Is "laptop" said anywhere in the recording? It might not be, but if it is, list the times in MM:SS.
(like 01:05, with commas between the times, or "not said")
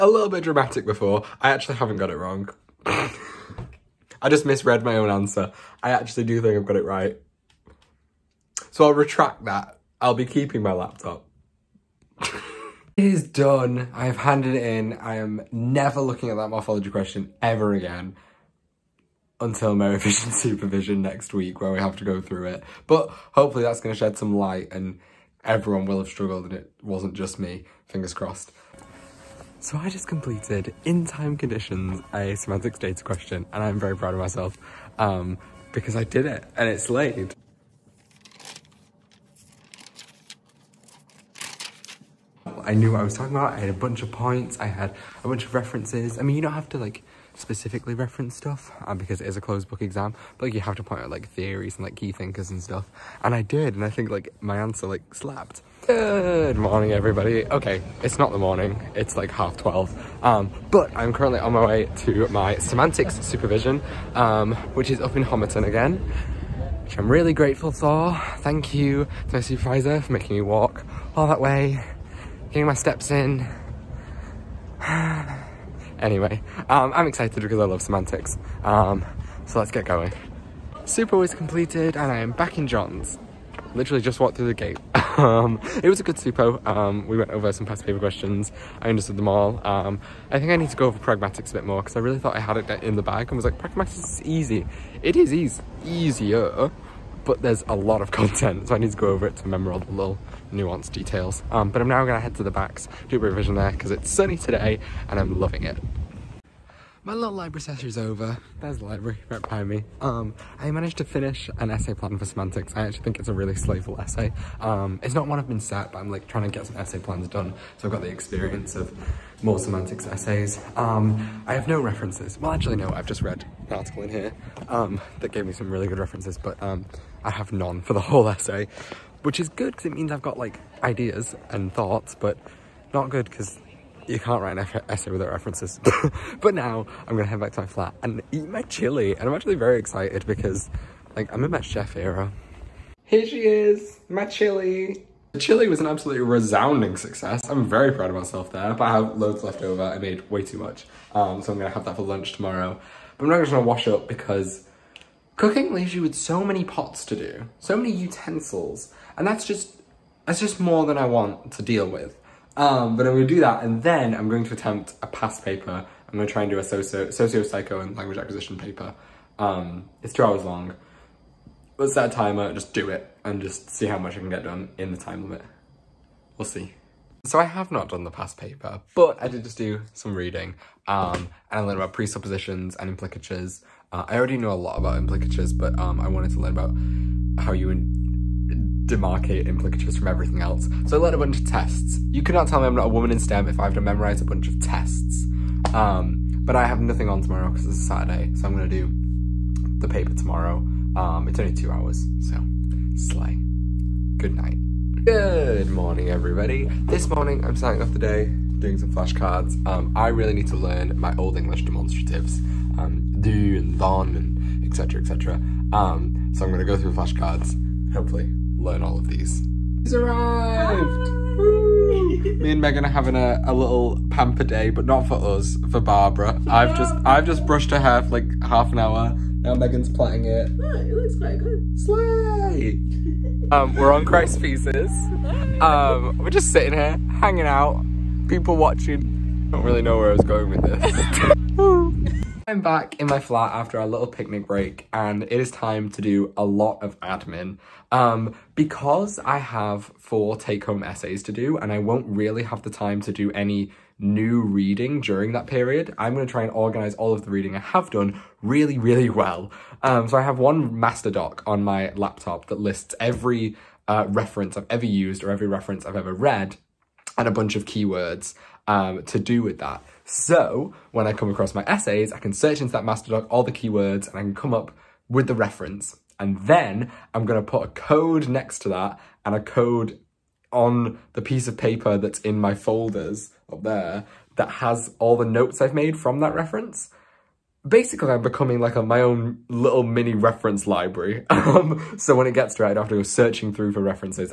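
00:10, 04:21.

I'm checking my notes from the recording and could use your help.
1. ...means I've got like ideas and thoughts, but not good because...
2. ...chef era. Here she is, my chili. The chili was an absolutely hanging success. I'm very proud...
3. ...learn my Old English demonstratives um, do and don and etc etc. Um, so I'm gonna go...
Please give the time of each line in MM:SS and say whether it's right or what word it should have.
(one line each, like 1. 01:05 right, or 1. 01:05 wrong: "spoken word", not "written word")
1. 02:09 right
2. 02:21 wrong: "resounding", not "hanging"
3. 03:30 right.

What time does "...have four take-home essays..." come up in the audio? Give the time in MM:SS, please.
04:09.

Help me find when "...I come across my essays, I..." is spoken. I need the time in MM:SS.
04:31.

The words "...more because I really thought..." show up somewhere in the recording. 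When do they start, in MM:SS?
01:31.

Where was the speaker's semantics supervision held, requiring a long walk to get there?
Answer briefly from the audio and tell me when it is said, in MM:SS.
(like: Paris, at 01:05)
Homerton, at 01:05.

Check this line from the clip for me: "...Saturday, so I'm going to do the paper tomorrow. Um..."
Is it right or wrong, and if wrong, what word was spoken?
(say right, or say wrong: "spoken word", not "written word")
right.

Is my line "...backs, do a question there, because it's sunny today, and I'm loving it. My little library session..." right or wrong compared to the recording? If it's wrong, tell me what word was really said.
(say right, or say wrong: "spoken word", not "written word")
wrong: "revision", not "question".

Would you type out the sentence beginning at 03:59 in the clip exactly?
I don't really know where I was going with this.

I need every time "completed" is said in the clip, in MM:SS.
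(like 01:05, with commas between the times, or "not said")
00:30, 01:21.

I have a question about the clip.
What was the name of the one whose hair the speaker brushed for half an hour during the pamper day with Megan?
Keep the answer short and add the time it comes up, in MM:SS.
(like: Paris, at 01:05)
Barbara, at 03:45.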